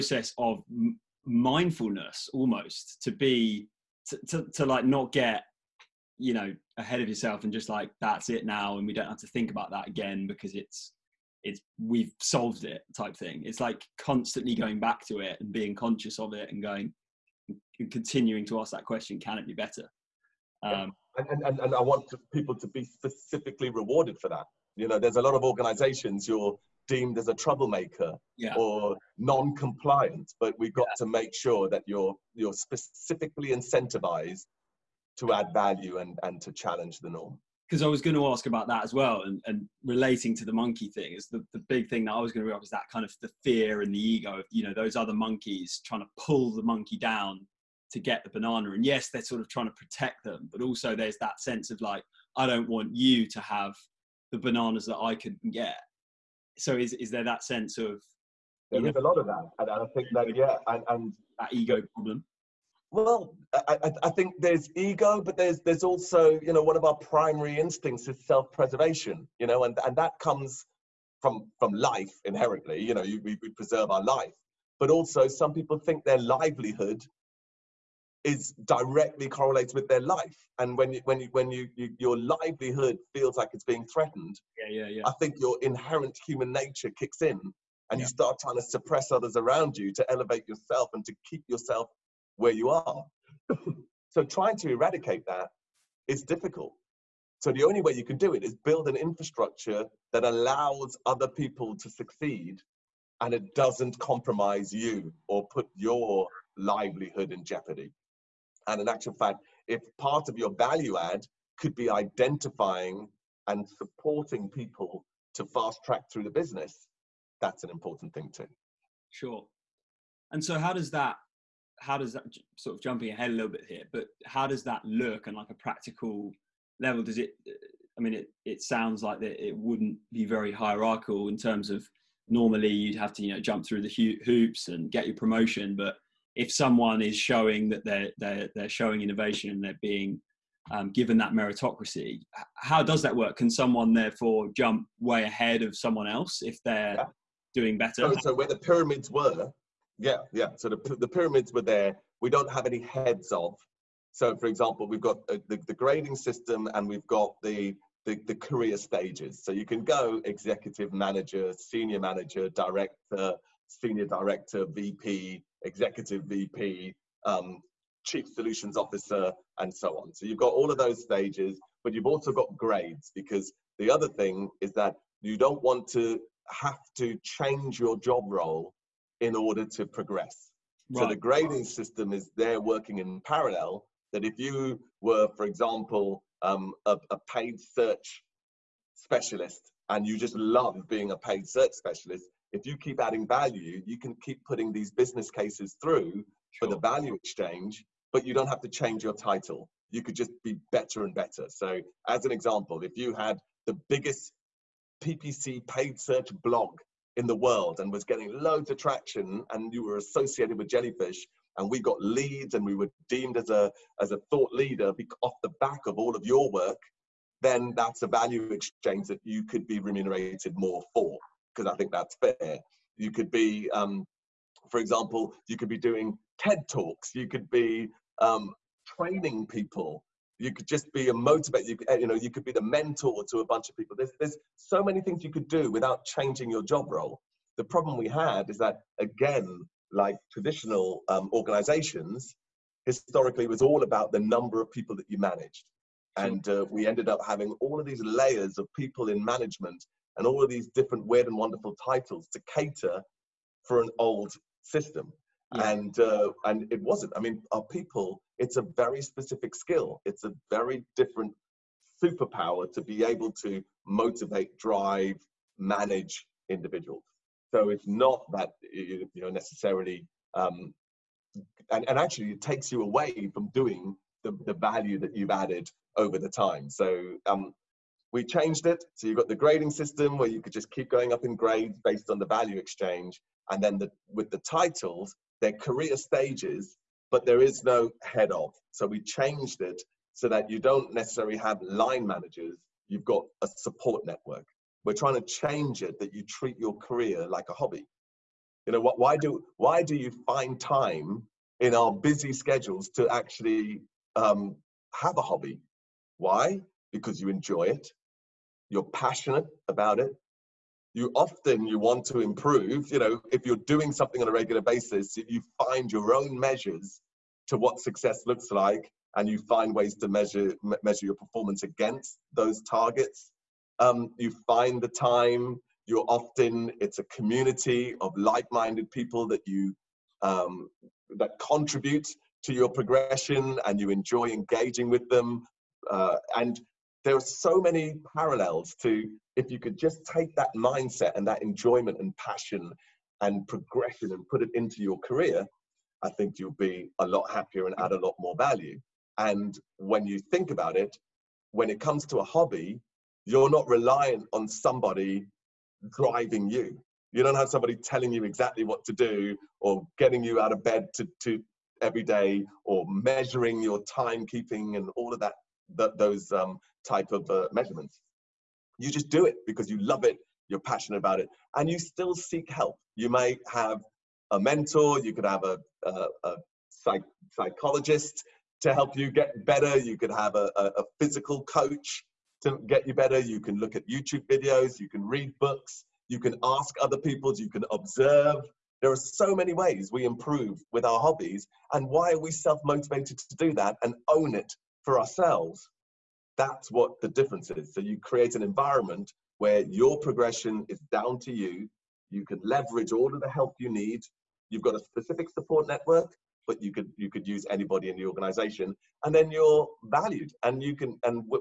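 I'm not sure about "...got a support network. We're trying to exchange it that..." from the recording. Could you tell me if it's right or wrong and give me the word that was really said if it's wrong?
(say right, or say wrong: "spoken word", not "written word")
wrong: "change", not "exchange".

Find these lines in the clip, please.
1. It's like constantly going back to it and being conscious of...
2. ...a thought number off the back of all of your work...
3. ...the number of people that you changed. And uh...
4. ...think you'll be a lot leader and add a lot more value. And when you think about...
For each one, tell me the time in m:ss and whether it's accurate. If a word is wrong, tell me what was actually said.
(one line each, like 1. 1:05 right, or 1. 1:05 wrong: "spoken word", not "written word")
1. 0:13 right
2. 3:34 wrong: "leader", not "number"
3. 4:04 wrong: "managed", not "changed"
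4. 5:46 wrong: "happier", not "leader".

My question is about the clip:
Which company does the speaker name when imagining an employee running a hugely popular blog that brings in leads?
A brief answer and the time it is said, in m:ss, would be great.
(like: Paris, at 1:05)
Jellyfish, at 3:30.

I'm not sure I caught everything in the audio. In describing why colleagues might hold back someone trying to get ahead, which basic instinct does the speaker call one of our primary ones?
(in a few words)
Self-preservation.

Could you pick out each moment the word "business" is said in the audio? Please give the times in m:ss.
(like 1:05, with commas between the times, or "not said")
1:56, 3:14.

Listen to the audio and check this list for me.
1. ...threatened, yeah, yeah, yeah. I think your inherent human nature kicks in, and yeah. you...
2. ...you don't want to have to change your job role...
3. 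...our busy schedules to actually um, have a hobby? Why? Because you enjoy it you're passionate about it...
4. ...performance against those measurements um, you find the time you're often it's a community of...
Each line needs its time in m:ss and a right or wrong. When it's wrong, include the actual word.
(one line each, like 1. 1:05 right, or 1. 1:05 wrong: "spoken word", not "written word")
1. 1:23 right
2. 2:55 right
3. 5:01 right
4. 5:21 wrong: "targets", not "measurements".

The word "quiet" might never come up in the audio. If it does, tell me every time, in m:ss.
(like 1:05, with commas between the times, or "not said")
not said.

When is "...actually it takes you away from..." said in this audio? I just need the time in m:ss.
4:31.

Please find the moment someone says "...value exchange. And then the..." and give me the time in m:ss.
4:42.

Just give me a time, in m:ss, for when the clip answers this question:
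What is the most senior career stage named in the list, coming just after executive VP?
2:48.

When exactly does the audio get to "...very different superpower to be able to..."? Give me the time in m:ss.
4:20.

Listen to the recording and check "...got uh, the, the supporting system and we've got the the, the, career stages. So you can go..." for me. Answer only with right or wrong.
wrong.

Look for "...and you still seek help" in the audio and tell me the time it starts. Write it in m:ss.
6:11.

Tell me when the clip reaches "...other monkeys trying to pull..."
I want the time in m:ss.
0:44.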